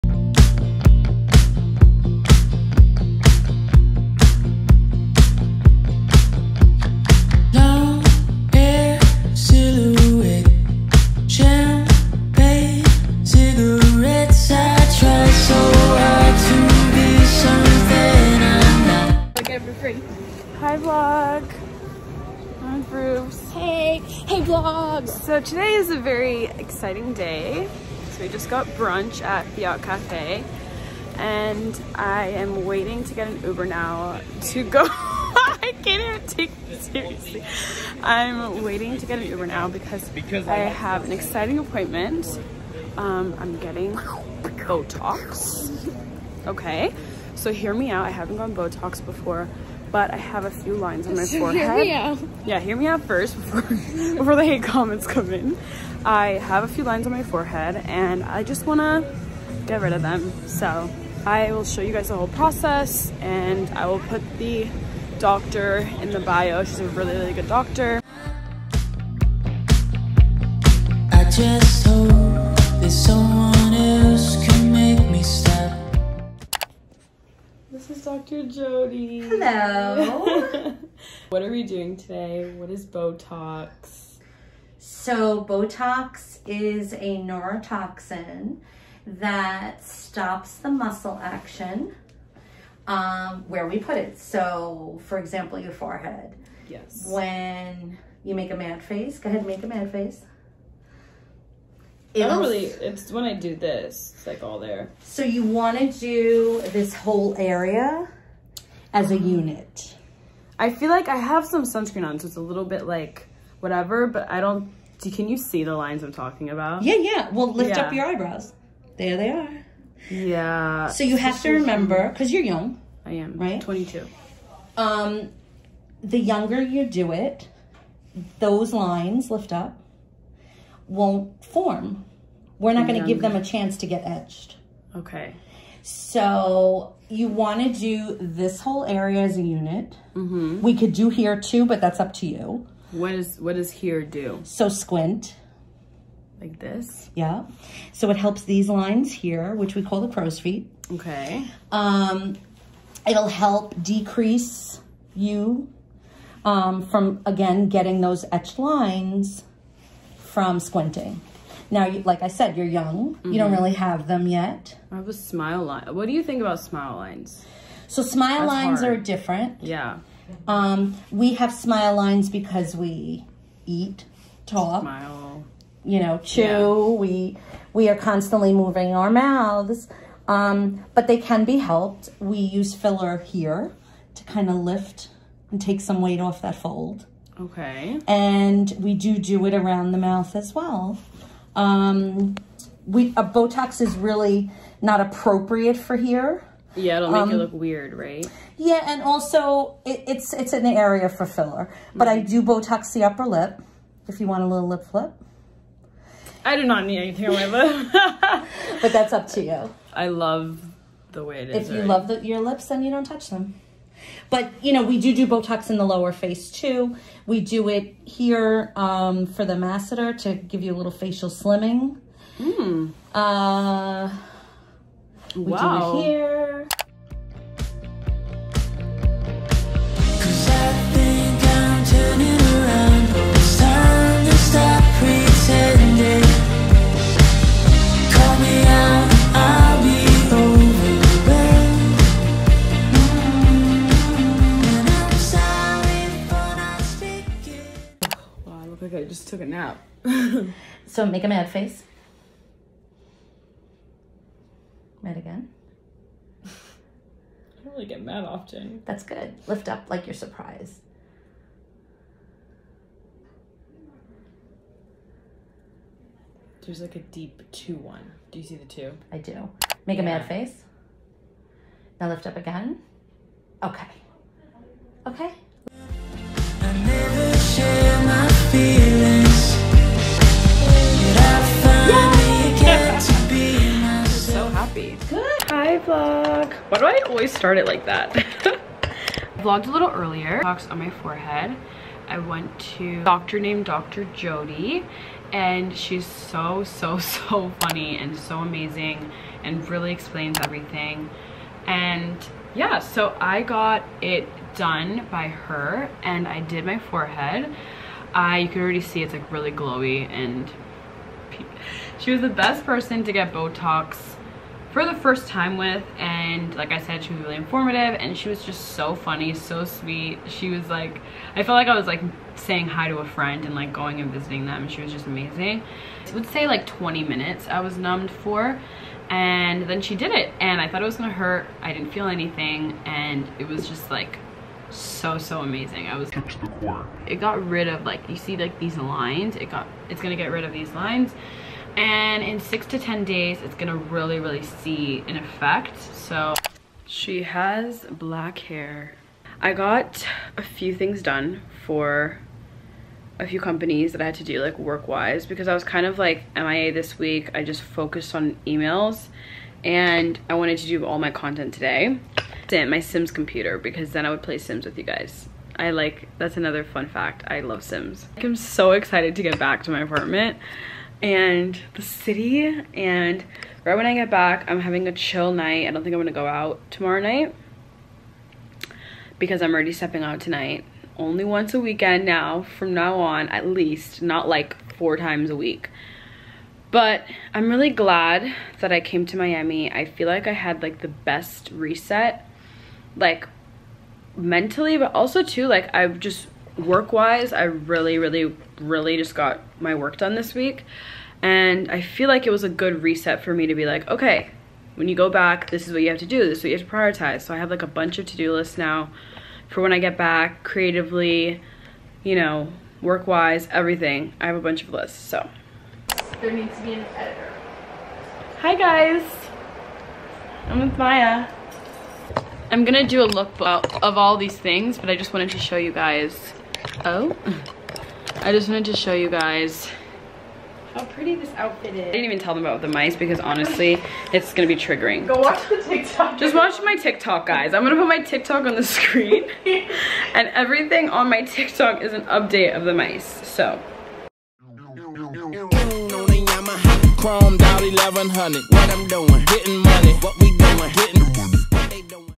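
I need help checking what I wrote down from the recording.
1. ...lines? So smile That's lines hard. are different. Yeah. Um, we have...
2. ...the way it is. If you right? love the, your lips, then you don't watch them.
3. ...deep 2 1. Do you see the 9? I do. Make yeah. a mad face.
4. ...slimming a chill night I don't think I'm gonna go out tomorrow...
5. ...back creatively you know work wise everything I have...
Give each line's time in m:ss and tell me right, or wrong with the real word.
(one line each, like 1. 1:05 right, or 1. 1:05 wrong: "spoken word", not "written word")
1. 2:47 right
2. 3:31 wrong: "touch", not "watch"
3. 4:26 wrong: "2", not "9"
4. 6:14 wrong: "having", not "slimming"
5. 6:49 right.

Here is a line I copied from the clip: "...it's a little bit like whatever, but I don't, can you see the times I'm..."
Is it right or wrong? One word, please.
wrong.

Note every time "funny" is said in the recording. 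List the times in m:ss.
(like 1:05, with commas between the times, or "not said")
4:57, 5:18.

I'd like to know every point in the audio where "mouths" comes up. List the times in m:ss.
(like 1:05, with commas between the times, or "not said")
2:59, 3:09.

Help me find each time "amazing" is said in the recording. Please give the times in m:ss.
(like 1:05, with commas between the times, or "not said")
4:58, 5:25, 5:35.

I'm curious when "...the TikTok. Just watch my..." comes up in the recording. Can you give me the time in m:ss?
7:15.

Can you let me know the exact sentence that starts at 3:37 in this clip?
We do it here um, for the masseter to give you a little facial slimming.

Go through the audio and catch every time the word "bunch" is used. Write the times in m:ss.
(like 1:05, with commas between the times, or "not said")
6:47, 6:54.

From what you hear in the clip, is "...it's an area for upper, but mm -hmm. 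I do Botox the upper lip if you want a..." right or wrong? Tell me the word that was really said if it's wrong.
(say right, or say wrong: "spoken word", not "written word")
wrong: "filler", not "upper".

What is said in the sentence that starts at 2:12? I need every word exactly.
We're not going to give them a chance to get etched.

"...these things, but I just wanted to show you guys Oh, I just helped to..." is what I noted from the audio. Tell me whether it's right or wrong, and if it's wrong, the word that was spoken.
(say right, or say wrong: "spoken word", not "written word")
wrong: "wanted", not "helped".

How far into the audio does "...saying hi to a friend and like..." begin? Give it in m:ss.
5:22.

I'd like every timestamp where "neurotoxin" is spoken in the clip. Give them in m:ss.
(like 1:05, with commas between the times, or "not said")
1:27.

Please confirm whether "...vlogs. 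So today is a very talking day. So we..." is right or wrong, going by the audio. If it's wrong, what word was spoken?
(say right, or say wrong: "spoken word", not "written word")
wrong: "exciting", not "talking".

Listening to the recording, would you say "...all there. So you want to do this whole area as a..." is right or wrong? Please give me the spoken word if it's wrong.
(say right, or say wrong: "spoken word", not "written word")
right.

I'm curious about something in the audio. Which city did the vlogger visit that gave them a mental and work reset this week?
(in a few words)
Miami.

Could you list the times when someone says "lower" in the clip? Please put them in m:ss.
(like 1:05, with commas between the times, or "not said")
3:35.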